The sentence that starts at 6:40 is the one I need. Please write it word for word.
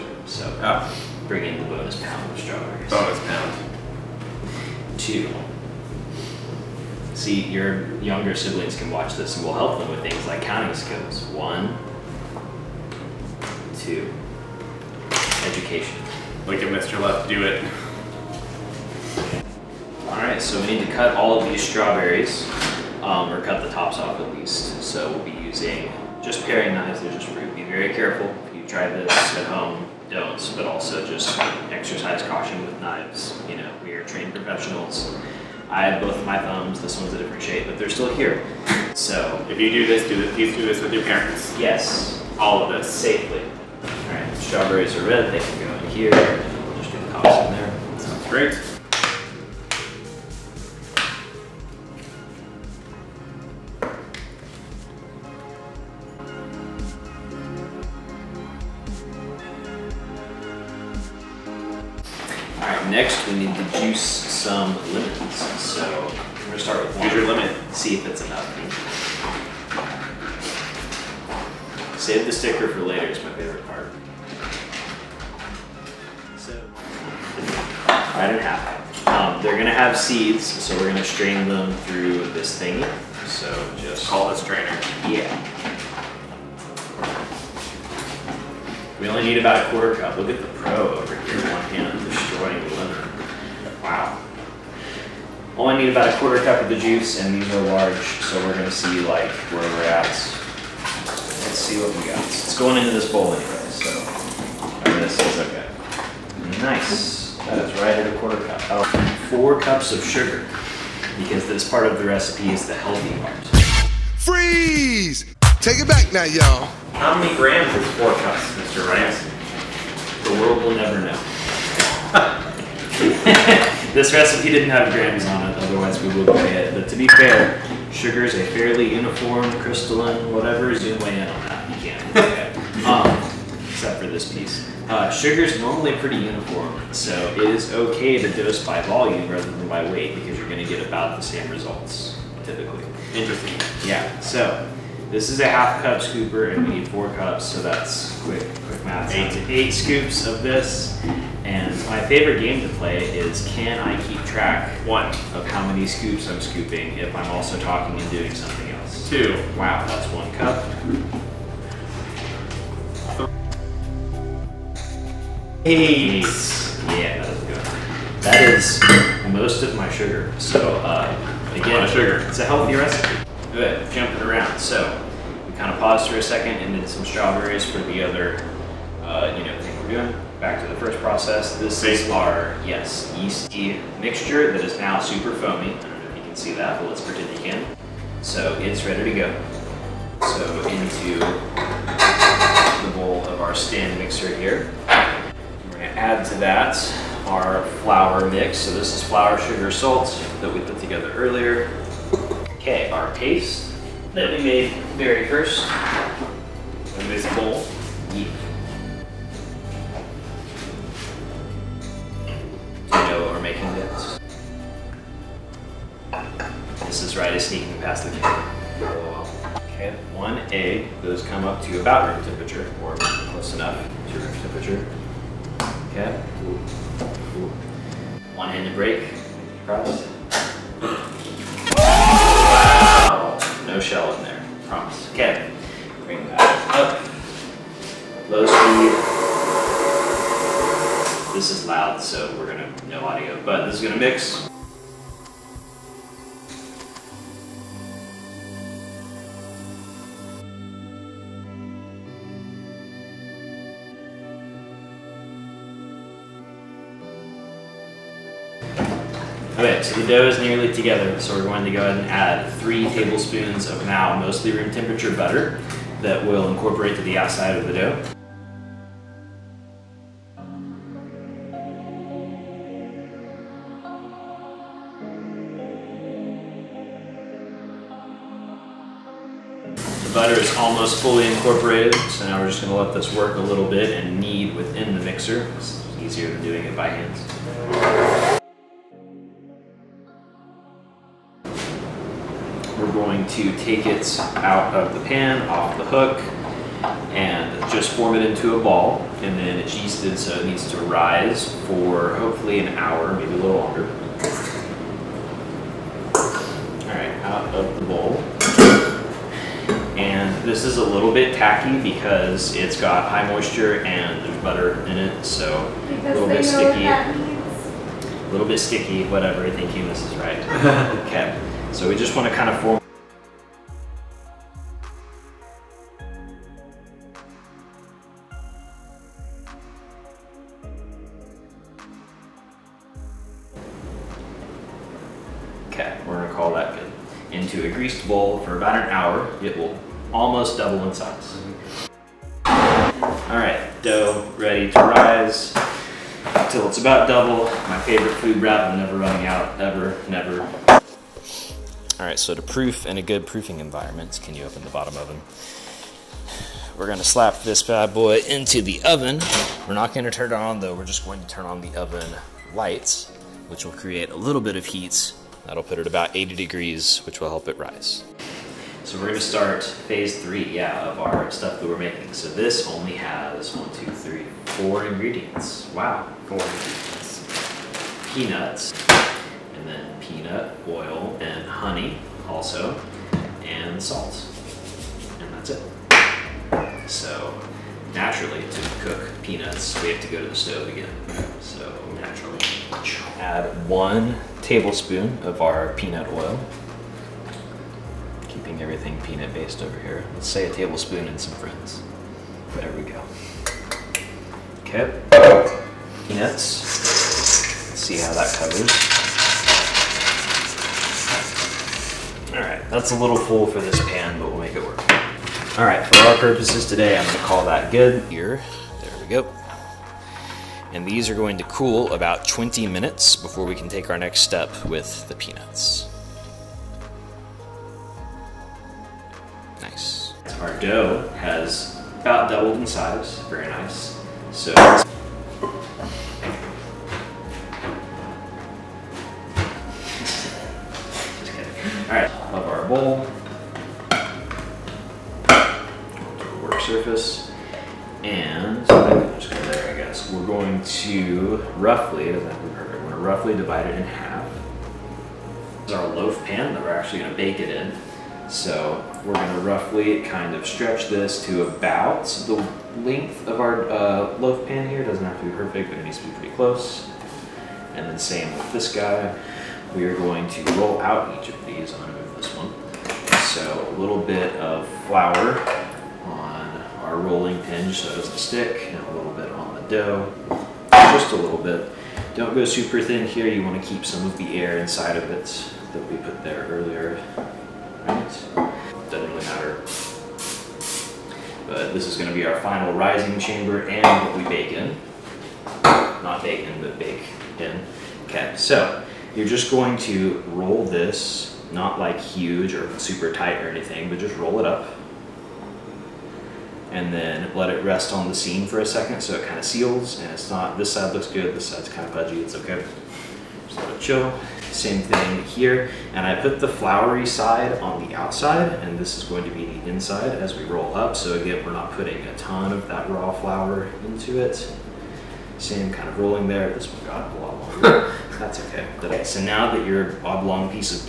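Let's say a tablespoon and some friends.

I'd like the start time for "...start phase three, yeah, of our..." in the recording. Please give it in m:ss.
6:09.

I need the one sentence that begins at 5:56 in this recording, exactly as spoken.
We're gonna slap this bad boy into the oven.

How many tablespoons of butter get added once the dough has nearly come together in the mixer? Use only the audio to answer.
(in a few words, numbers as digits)
3.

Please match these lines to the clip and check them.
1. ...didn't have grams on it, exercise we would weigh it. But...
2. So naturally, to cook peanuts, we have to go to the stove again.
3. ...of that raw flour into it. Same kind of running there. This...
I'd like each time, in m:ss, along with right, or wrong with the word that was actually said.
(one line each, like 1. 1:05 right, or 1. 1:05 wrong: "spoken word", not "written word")
1. 2:04 wrong: "otherwise", not "exercise"
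2. 6:26 right
3. 8:42 wrong: "rolling", not "running".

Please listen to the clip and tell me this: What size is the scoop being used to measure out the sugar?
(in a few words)
half cup.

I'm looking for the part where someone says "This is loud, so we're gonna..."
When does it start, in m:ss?
4:01.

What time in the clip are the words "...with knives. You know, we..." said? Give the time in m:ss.
0:32.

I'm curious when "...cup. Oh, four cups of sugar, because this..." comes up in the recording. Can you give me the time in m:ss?
1:48.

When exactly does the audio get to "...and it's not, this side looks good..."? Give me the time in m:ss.
8:29.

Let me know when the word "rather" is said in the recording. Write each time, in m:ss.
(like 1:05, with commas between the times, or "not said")
2:19.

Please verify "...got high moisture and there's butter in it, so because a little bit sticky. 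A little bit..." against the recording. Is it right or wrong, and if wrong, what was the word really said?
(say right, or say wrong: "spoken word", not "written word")
right.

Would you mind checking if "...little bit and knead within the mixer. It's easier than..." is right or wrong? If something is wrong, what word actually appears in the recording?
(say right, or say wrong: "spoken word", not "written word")
right.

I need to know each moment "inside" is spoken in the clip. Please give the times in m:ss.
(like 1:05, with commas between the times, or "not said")
8:04, 8:39.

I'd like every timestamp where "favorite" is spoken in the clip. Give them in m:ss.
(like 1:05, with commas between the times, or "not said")
2:32, 5:47.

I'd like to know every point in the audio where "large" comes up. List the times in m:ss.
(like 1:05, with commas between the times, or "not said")
1:37.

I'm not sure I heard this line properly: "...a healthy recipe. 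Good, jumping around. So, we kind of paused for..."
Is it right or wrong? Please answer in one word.
right.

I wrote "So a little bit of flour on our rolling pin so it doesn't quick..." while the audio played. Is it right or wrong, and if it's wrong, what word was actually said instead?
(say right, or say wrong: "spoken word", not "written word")
wrong: "stick", not "quick".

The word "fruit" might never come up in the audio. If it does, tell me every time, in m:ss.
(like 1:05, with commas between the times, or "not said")
0:27.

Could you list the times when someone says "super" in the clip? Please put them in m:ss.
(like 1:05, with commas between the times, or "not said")
3:04, 8:02, 8:22.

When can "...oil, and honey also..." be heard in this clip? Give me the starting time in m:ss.
6:20.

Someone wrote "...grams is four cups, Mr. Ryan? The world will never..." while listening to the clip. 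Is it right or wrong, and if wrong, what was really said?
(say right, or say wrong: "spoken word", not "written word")
right.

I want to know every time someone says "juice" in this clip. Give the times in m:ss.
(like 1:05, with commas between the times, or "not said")
1:36.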